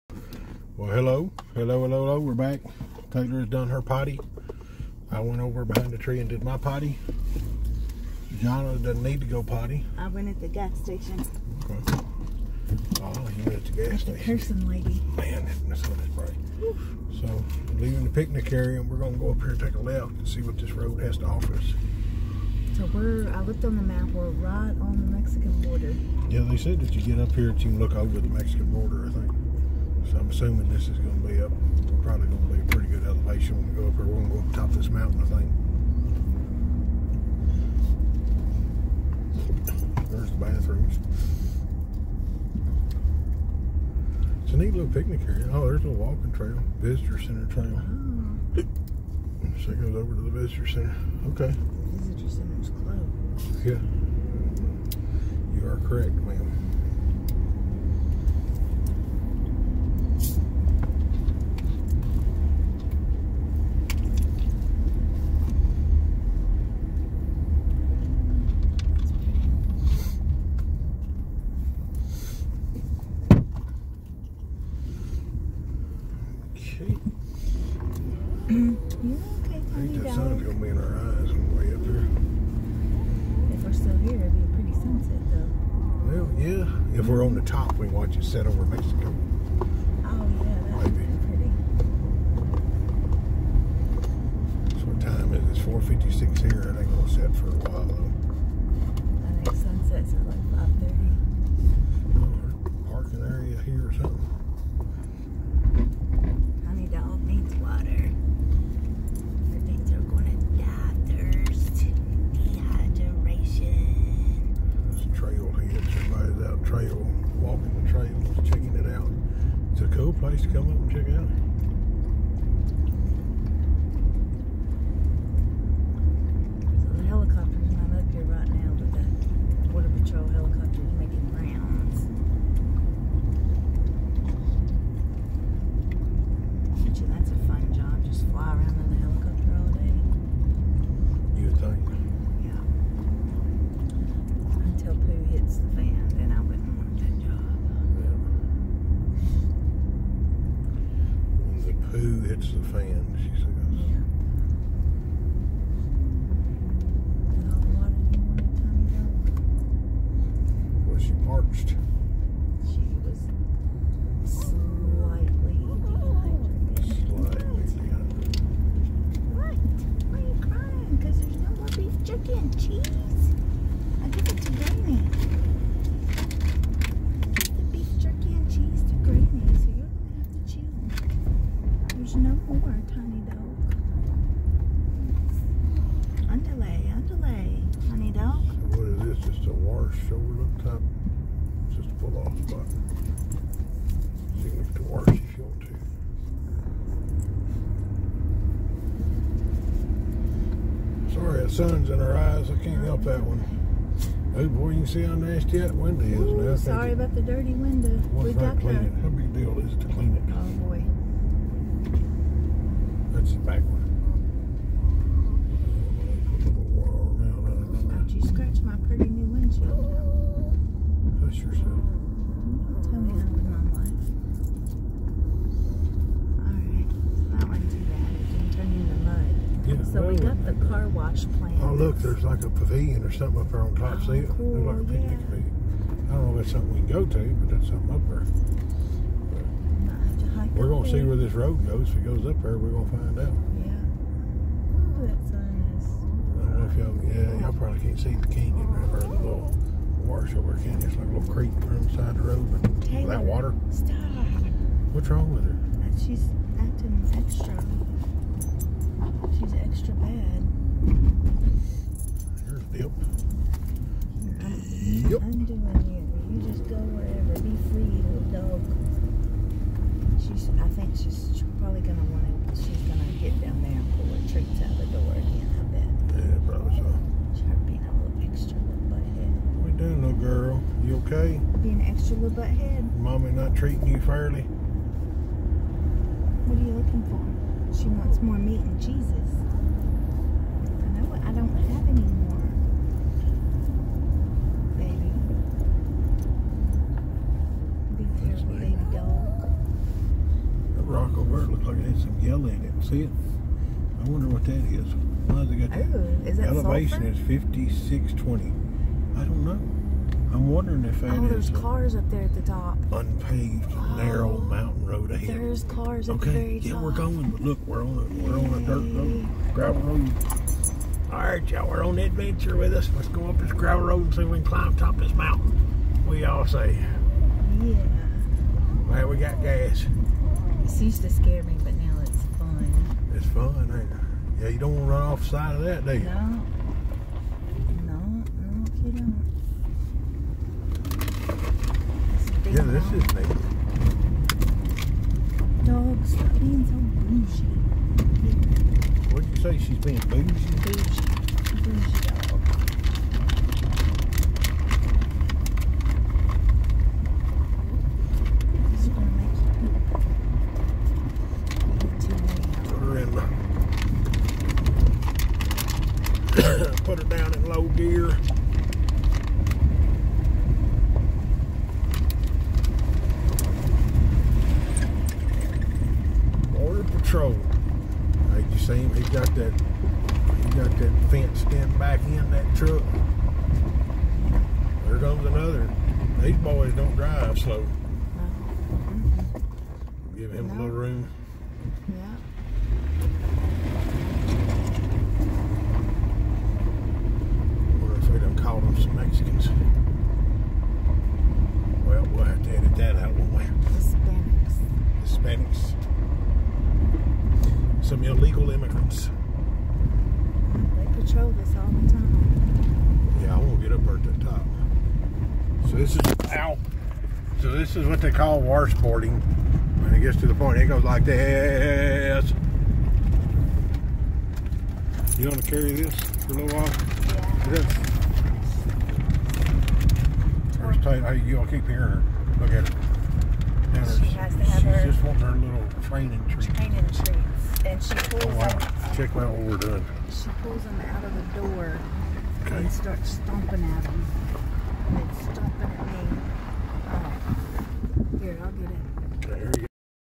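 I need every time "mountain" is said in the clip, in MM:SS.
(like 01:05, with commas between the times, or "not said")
00:34, 05:14, 05:25.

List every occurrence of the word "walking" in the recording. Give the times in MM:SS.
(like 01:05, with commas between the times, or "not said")
00:45.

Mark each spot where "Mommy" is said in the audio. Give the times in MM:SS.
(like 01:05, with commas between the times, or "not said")
04:42.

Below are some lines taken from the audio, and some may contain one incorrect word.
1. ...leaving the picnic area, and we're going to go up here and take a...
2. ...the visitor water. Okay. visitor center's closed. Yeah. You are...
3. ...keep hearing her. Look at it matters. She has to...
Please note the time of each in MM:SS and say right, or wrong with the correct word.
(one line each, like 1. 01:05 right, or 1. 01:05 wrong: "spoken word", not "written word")
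1. 00:17 right
2. 00:50 wrong: "center", not "water"
3. 07:11 right.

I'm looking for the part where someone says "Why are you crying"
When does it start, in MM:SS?
02:50.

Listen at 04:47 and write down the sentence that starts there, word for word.
She wants more meat and cheeses.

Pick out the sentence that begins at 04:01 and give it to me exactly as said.
If it goes up there, we're gonna find out.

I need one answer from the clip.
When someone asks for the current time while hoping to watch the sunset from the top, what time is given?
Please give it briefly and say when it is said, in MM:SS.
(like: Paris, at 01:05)
4:56, at 01:35.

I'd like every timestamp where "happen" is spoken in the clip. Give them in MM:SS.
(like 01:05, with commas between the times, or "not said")
not said.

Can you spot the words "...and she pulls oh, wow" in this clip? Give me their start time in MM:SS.
07:17.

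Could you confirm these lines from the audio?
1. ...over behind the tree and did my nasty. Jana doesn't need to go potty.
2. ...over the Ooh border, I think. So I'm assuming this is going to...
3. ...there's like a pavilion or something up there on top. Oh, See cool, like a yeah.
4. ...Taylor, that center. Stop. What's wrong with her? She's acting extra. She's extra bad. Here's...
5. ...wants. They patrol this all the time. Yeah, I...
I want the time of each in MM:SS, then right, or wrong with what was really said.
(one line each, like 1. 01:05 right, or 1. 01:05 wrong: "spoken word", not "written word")
1. 00:05 wrong: "potty", not "nasty"
2. 00:27 wrong: "Mexican", not "Ooh"
3. 03:51 right
4. 04:12 wrong: "water", not "center"
5. 06:48 wrong: "immigrants", not "wants".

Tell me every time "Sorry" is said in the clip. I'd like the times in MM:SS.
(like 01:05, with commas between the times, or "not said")
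03:21, 03:26.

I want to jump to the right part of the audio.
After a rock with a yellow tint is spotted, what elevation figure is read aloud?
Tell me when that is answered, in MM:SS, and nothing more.
05:08.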